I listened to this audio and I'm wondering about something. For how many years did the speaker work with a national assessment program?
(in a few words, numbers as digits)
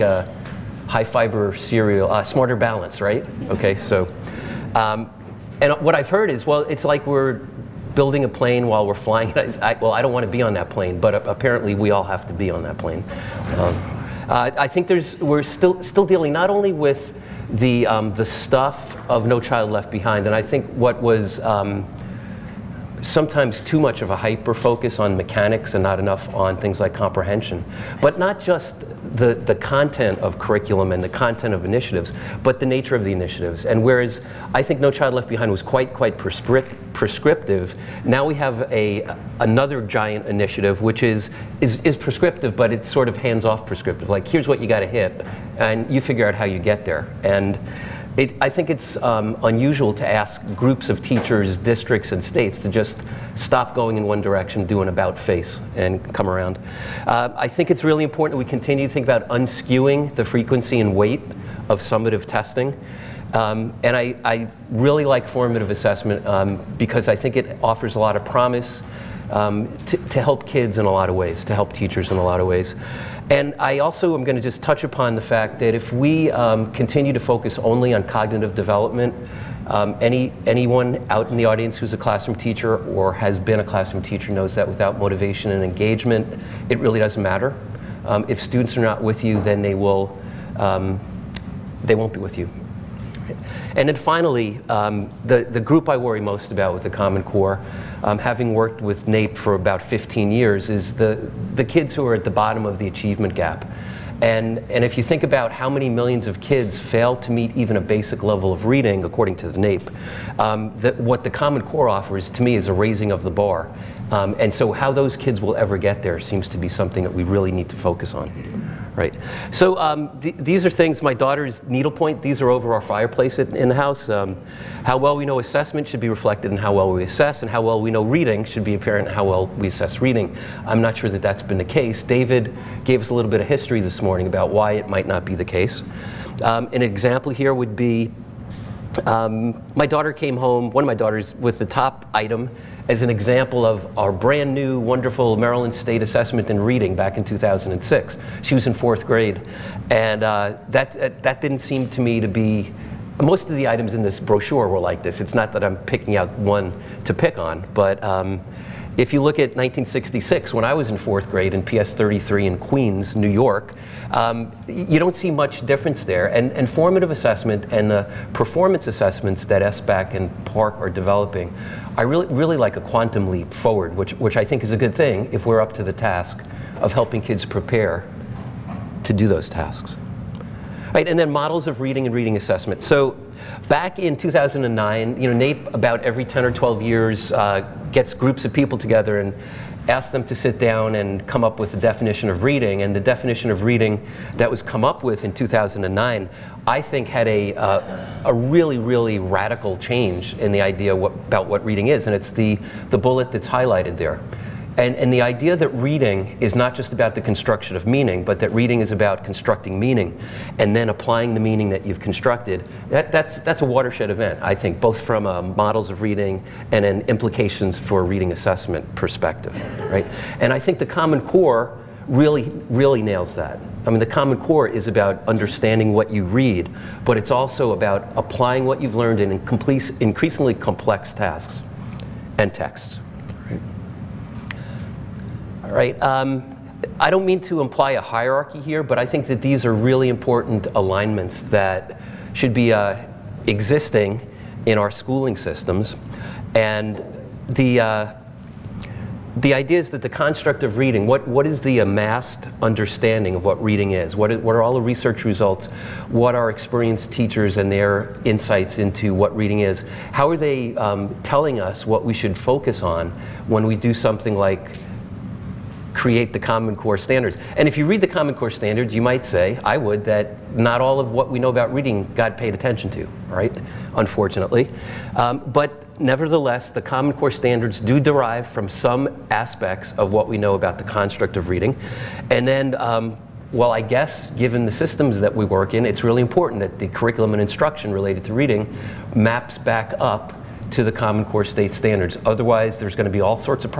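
15.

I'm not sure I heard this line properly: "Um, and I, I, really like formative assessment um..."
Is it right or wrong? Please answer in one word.
right.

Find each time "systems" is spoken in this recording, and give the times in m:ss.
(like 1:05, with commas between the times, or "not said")
4:05, 4:44.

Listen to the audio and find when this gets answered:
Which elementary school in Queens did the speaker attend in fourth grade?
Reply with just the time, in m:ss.
2:41.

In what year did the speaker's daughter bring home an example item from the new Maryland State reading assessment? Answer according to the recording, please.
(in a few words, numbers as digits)
2006.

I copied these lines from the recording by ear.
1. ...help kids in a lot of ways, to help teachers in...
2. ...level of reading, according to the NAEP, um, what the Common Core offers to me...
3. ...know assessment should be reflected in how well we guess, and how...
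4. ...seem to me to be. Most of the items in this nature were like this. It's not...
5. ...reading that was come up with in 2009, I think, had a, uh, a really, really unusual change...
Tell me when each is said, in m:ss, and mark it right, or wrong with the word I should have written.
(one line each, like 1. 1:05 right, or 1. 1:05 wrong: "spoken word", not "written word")
1. 1:10 right
2. 1:48 right
3. 2:05 wrong: "assess", not "guess"
4. 2:31 wrong: "brochure", not "nature"
5. 3:13 wrong: "radical", not "unusual".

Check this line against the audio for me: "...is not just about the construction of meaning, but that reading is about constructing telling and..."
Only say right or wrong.
wrong.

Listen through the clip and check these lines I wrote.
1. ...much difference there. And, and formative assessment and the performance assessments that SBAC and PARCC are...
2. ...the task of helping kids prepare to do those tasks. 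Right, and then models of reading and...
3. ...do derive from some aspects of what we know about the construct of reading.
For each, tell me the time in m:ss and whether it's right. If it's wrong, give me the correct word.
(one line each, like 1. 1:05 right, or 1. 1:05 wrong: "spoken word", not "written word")
1. 2:45 right
2. 2:55 right
3. 4:37 right.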